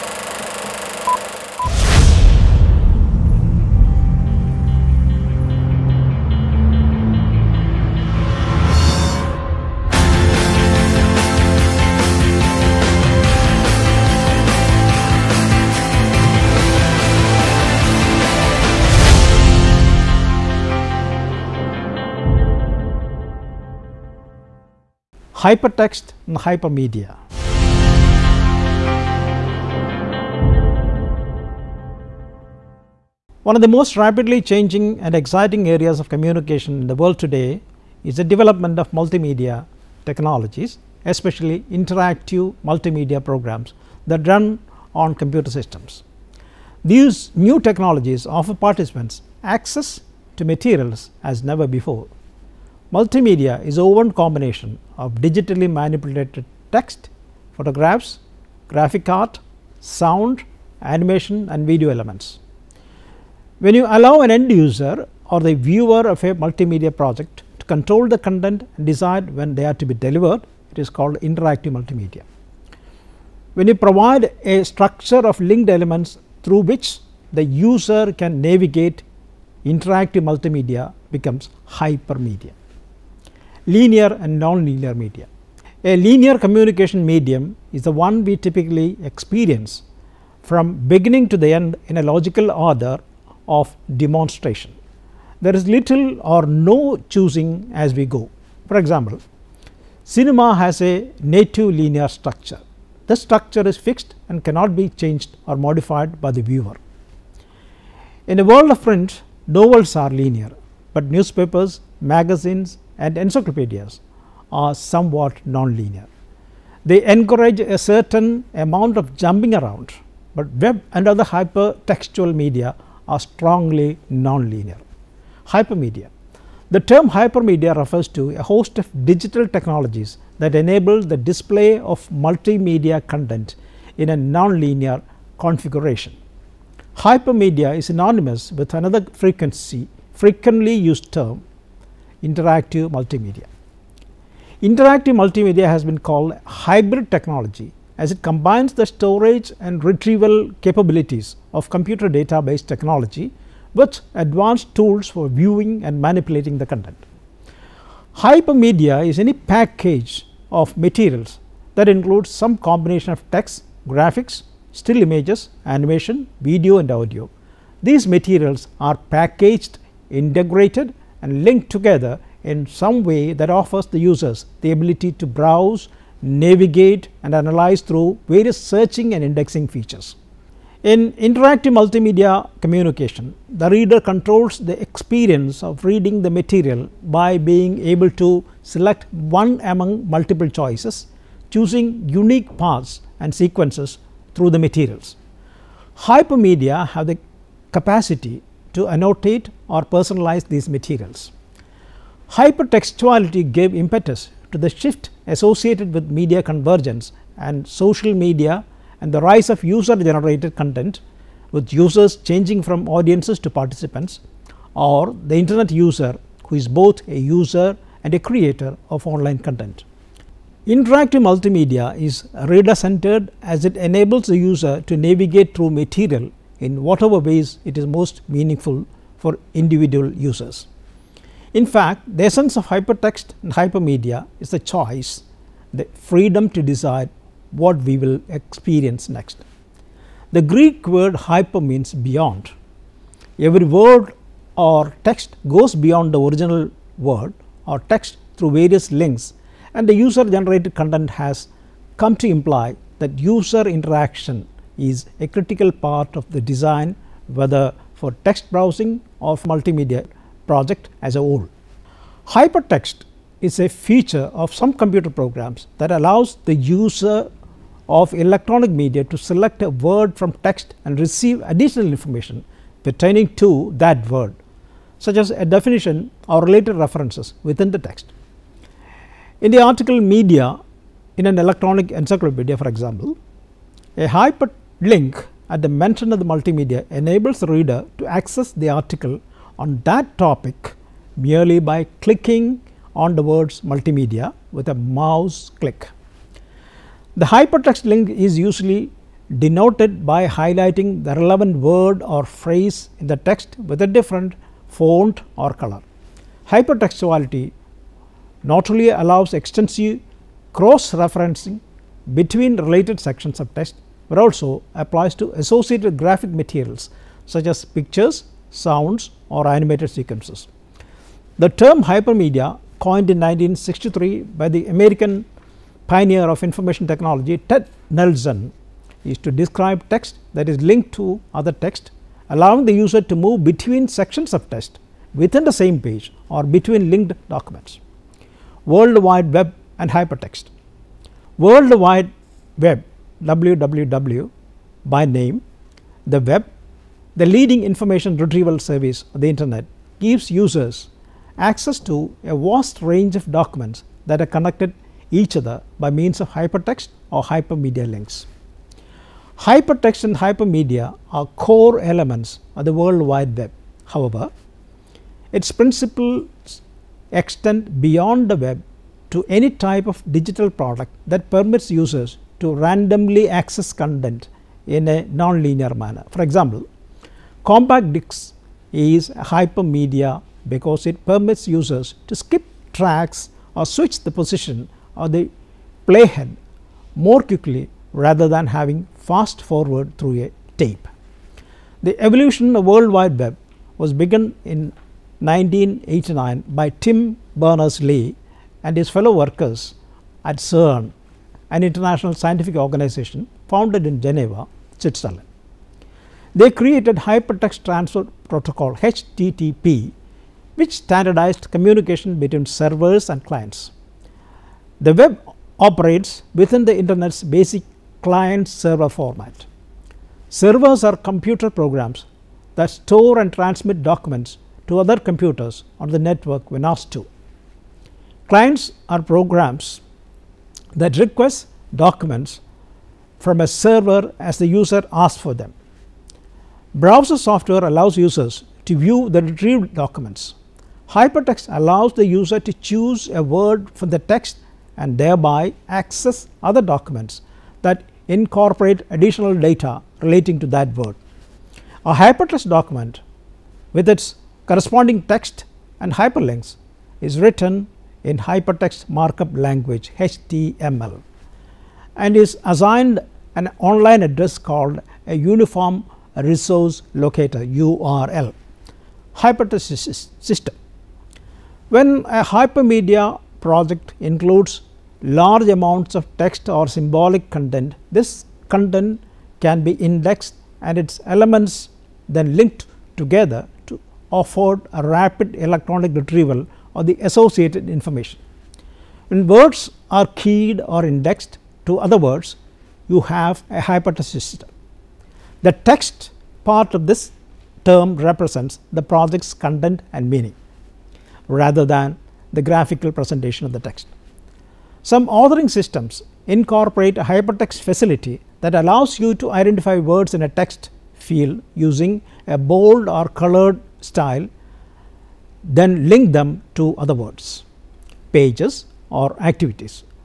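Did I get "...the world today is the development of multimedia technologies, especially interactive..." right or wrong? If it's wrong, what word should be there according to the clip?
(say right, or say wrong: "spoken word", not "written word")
right.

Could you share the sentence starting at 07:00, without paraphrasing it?
Servers are computer programs that store and transmit documents to other computers on the network when asked to.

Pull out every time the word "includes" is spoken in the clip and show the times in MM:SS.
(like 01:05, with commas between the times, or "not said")
02:41, 07:54.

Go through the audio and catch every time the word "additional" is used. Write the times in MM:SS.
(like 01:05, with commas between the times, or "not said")
04:31, 07:28.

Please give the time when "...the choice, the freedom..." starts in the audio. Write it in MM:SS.
03:54.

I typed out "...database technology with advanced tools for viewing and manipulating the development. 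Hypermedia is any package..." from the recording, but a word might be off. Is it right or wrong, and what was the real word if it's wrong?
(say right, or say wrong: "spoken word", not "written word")
wrong: "content", not "development".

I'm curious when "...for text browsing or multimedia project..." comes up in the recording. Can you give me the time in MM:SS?
04:17.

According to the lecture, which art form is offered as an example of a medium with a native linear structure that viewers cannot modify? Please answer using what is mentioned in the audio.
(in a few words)
Cinema.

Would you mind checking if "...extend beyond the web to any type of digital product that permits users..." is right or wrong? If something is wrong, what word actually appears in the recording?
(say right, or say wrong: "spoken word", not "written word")
right.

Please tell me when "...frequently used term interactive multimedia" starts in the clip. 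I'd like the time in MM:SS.
02:20.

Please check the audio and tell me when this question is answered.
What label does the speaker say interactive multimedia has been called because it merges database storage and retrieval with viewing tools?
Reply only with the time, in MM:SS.
02:26.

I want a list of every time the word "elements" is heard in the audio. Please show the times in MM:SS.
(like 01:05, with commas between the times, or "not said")
01:01, 01:15, 06:01, 08:01.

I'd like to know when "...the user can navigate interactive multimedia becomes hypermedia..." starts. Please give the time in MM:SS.
01:17.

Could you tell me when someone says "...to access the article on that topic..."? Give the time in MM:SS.
04:47.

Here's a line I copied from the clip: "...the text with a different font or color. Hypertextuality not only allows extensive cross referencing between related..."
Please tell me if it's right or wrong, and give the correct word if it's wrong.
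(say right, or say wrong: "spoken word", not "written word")
right.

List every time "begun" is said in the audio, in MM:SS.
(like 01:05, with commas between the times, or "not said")
06:33.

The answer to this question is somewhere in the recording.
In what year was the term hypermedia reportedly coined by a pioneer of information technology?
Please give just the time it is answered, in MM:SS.
05:23.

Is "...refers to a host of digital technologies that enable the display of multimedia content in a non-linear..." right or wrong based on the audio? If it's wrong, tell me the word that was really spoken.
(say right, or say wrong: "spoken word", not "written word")
right.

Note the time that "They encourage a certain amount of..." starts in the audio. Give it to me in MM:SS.
01:56.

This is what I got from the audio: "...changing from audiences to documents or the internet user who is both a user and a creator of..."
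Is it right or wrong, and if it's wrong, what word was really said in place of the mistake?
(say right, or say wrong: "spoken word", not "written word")
wrong: "participants", not "documents".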